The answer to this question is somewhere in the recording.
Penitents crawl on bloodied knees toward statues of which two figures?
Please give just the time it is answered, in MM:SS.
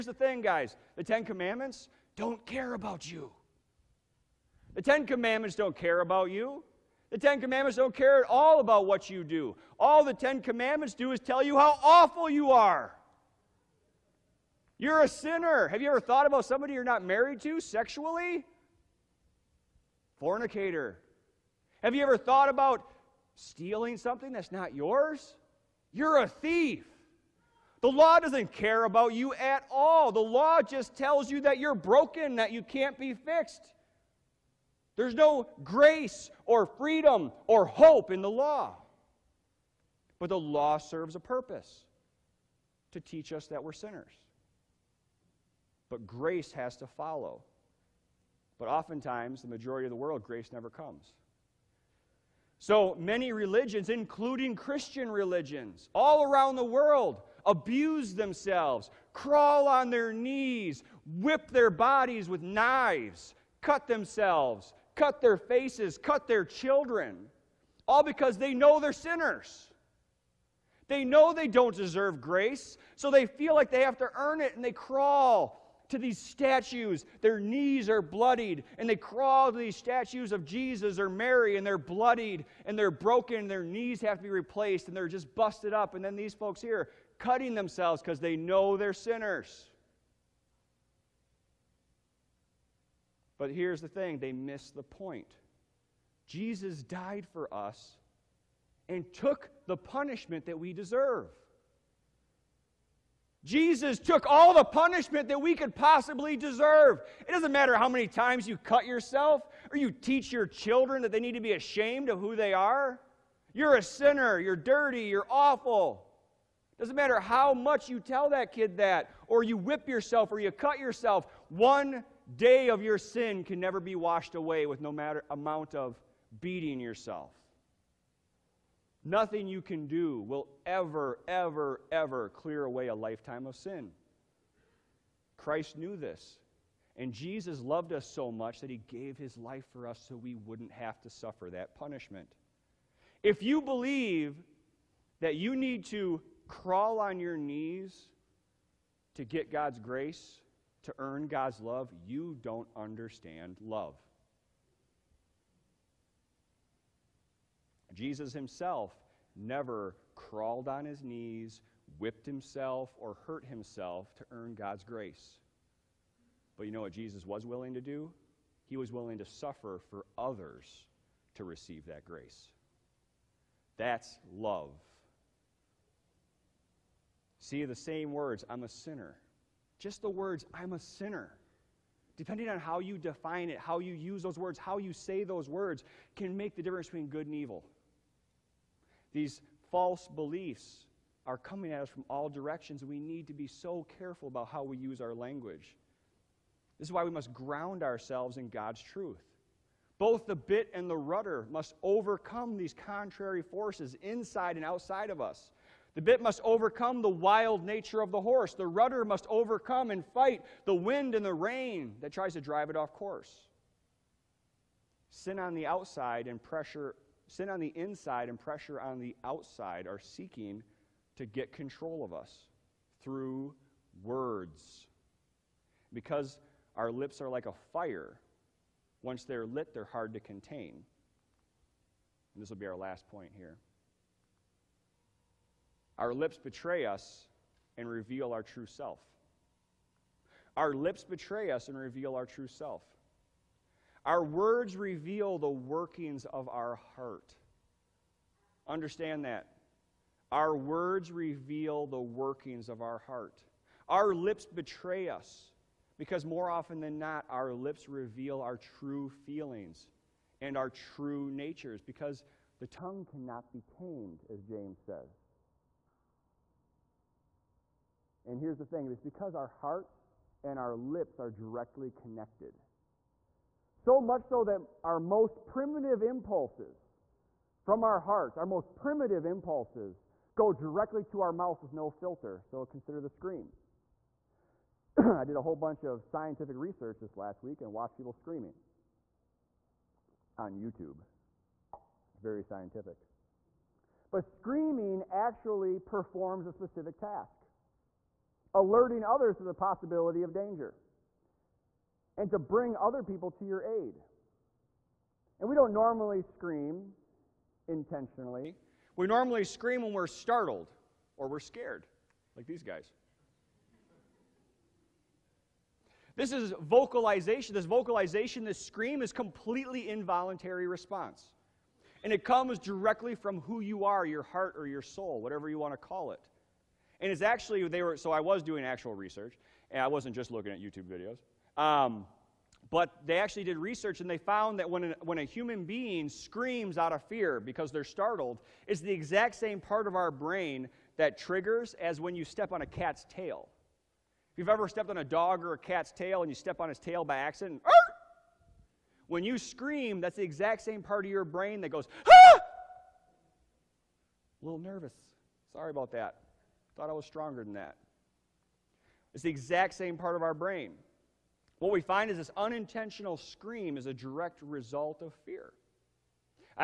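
01:20.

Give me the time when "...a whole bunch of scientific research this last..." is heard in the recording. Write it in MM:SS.
04:45.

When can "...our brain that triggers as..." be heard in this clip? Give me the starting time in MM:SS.
05:39.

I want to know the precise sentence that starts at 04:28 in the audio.
And here's the thing it's because our hearts and our lips are directly connected.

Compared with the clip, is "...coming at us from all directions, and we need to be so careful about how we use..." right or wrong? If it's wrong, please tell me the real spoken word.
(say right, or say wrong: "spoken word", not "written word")
right.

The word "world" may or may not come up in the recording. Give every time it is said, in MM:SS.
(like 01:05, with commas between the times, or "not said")
00:49, 00:56.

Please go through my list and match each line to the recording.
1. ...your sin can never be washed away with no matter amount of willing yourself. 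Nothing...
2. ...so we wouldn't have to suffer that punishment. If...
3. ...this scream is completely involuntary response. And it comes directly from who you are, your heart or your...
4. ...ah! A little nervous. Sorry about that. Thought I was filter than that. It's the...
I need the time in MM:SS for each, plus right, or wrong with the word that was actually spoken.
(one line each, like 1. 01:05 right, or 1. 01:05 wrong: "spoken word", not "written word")
1. 02:02 wrong: "beating", not "willing"
2. 02:20 right
3. 05:18 right
4. 05:52 wrong: "stronger", not "filter".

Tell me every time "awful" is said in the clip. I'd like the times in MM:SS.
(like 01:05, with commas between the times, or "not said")
00:11, 01:55.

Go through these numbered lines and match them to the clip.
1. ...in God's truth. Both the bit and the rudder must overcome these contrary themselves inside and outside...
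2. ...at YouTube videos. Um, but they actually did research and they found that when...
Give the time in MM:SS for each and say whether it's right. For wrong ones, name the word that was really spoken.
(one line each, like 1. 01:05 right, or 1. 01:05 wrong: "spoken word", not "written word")
1. 03:18 wrong: "forces", not "themselves"
2. 05:30 right.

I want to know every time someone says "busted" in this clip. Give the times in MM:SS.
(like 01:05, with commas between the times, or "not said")
01:25.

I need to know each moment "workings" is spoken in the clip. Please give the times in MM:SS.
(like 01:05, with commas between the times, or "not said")
04:05, 04:12.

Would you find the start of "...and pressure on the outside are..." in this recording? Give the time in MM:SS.
03:38.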